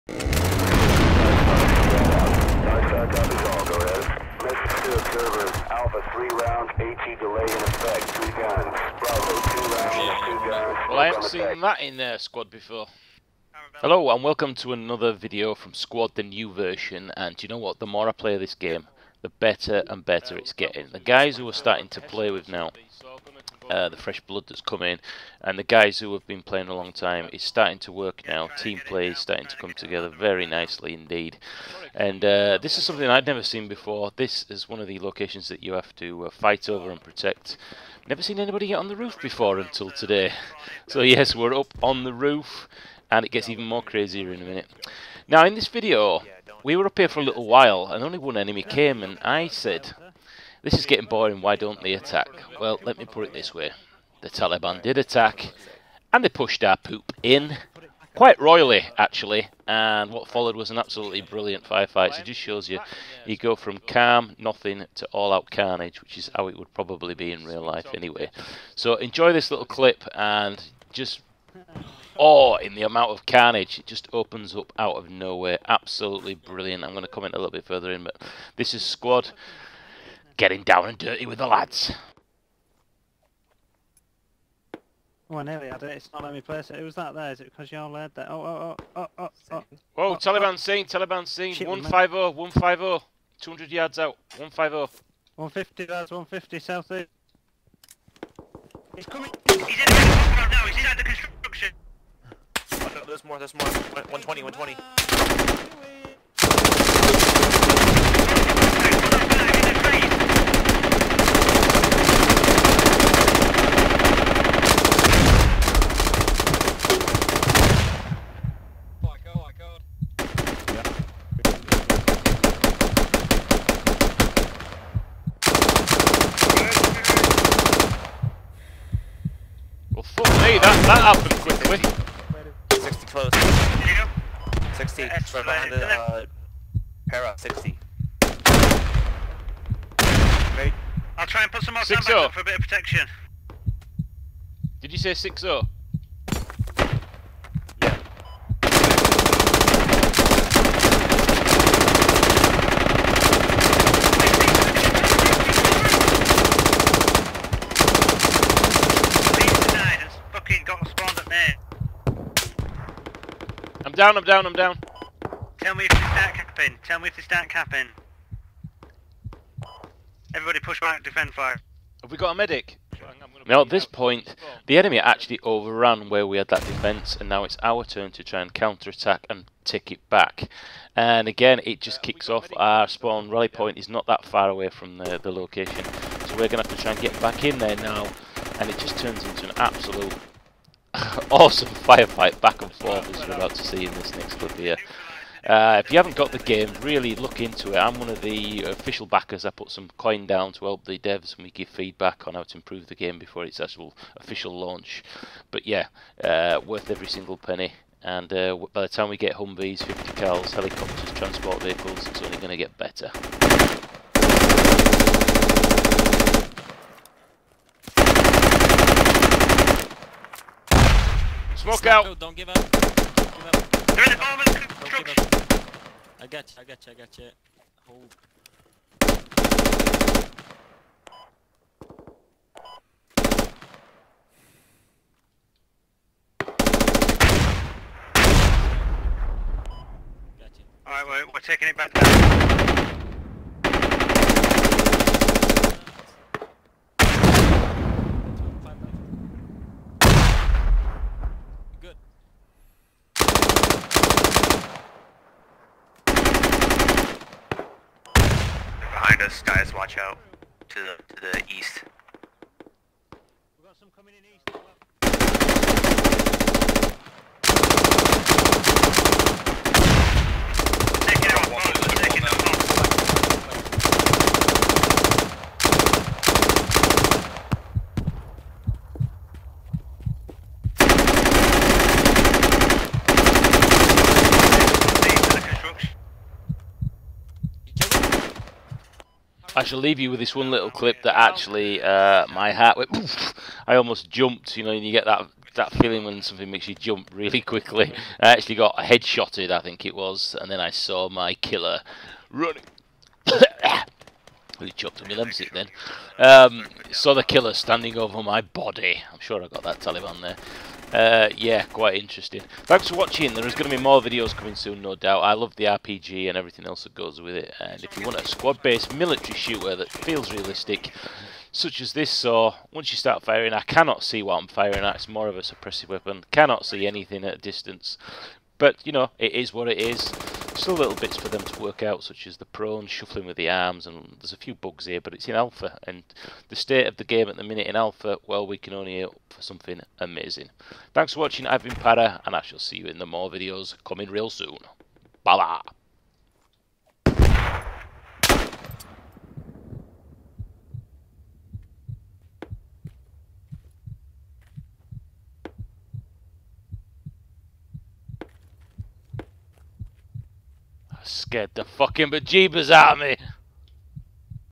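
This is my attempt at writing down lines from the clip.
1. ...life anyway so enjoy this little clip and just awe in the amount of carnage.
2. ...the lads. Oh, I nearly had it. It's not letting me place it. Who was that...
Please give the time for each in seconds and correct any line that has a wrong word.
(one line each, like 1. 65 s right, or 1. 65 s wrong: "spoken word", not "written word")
1. 67 s right
2. 81 s right.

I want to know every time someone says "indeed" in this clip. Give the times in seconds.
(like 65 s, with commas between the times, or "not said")
30 s.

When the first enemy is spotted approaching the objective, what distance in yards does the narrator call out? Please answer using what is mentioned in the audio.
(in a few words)
200 yards.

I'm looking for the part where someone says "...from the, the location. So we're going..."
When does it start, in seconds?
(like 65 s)
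184 s.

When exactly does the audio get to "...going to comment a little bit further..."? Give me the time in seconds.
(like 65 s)
76 s.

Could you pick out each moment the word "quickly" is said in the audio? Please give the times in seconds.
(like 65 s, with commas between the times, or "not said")
131 s, 297 s.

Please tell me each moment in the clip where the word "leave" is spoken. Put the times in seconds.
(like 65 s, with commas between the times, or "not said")
289 s.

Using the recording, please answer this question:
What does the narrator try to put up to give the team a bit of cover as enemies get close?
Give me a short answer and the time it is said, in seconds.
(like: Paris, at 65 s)
sandbags, at 141 s.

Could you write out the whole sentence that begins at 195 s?
Uh, if you haven't got the game, really look into it.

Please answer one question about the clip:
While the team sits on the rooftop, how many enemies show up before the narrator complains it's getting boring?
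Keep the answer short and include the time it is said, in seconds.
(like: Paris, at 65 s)
1, at 48 s.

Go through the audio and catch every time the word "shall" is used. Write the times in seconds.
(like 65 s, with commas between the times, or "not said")
289 s, 342 s.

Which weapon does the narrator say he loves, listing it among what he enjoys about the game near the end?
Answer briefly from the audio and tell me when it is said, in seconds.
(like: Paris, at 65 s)
RPG, at 315 s.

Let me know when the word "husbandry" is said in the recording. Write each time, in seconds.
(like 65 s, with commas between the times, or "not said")
not said.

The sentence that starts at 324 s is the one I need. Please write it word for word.
It's more of a suppressive weapon.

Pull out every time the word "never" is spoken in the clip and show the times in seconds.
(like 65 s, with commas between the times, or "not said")
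33 s, 38 s.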